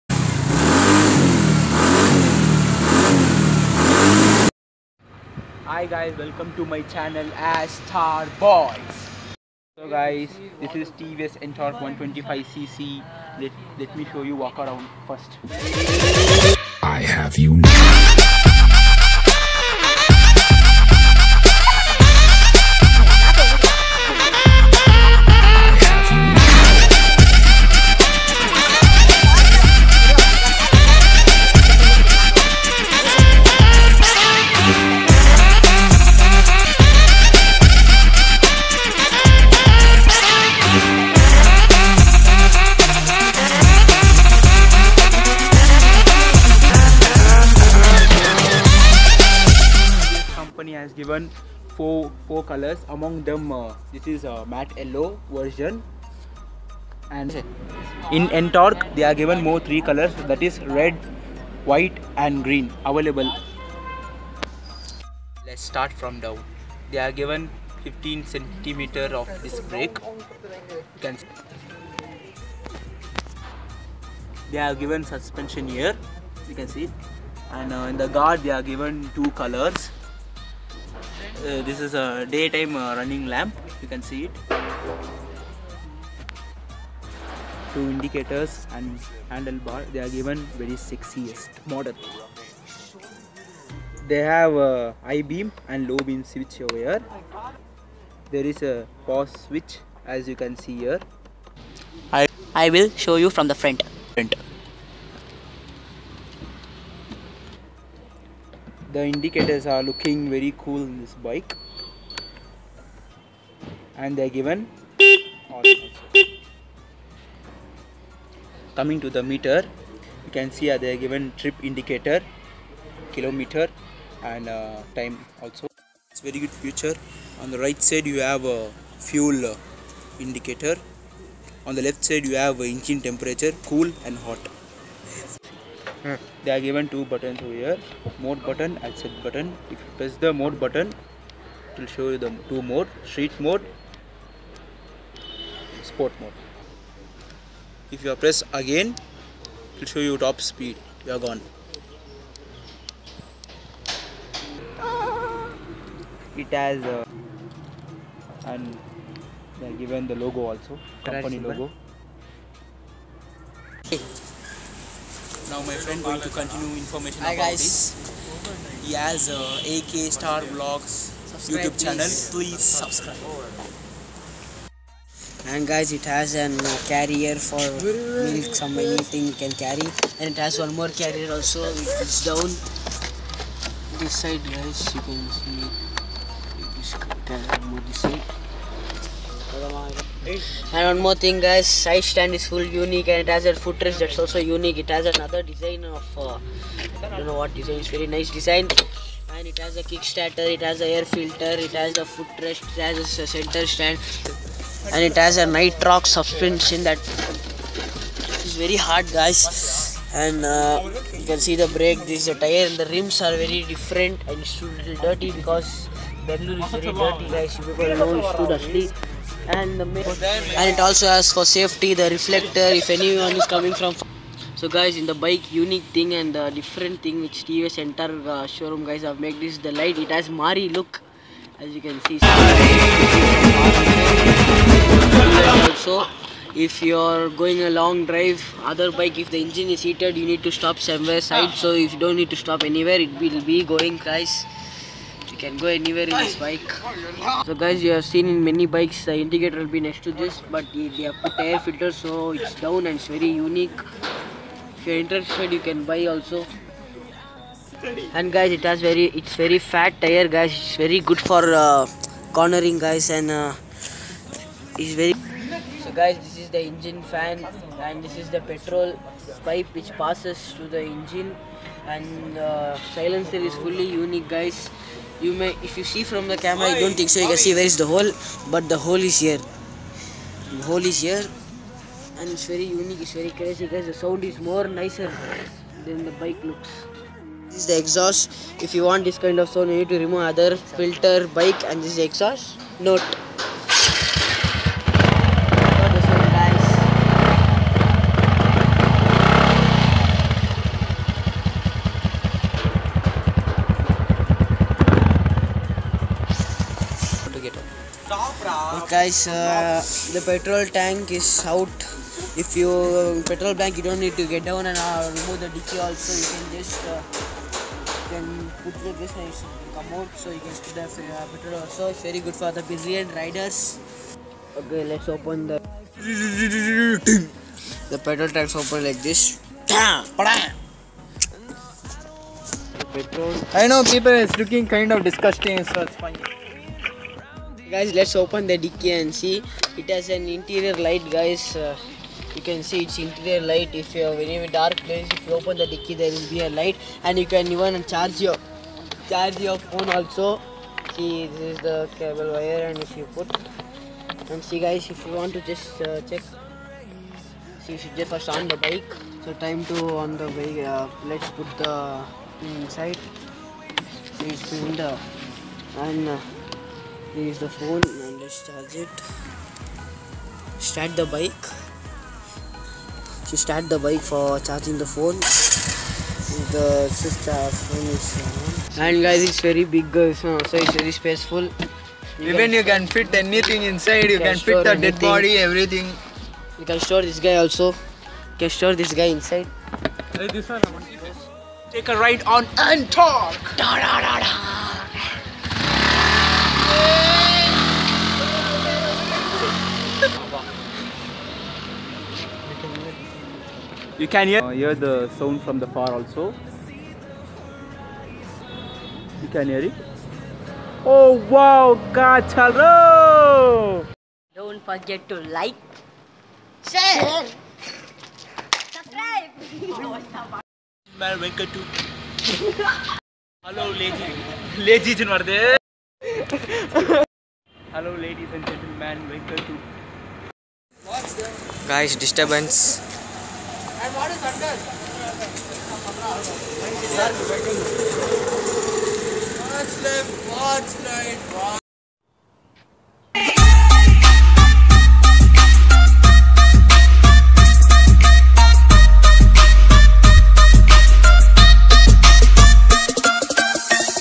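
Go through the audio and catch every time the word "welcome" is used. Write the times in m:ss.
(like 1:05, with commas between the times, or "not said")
0:06, 7:09.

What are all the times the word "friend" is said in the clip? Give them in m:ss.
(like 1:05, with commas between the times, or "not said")
2:45.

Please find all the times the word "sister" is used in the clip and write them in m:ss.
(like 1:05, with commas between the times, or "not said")
6:16.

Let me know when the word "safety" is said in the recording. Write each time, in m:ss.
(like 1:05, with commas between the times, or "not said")
3:41.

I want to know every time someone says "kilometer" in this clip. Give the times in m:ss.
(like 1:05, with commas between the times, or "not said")
2:03.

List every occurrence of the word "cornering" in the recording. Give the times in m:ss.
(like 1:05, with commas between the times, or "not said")
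4:22.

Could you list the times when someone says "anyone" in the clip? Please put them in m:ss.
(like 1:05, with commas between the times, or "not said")
3:42.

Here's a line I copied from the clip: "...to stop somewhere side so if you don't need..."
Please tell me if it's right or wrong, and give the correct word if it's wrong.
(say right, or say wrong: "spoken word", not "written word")
right.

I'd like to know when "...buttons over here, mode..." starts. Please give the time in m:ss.
2:17.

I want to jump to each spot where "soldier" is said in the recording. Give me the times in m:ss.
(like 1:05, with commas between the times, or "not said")
not said.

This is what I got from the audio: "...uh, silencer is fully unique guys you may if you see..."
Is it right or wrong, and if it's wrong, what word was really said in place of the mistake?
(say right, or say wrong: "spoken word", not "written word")
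right.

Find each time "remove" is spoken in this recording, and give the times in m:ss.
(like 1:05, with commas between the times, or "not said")
4:50, 5:15.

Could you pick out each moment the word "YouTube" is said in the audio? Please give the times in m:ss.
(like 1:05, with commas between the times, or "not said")
2:51.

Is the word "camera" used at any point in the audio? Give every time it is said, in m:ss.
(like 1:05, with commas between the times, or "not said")
4:36.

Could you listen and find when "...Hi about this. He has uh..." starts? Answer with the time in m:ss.
2:47.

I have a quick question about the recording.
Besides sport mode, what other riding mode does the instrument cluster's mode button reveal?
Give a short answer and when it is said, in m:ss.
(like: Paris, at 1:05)
Street mode, at 2:23.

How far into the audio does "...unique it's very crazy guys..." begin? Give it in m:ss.
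4:42.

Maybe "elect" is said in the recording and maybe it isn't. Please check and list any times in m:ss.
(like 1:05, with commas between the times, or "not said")
not said.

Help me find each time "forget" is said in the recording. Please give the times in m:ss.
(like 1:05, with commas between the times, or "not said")
6:54.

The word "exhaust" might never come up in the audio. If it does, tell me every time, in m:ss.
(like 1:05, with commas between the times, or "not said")
4:47, 4:52.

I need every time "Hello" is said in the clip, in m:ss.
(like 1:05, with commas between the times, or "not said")
7:03, 7:07.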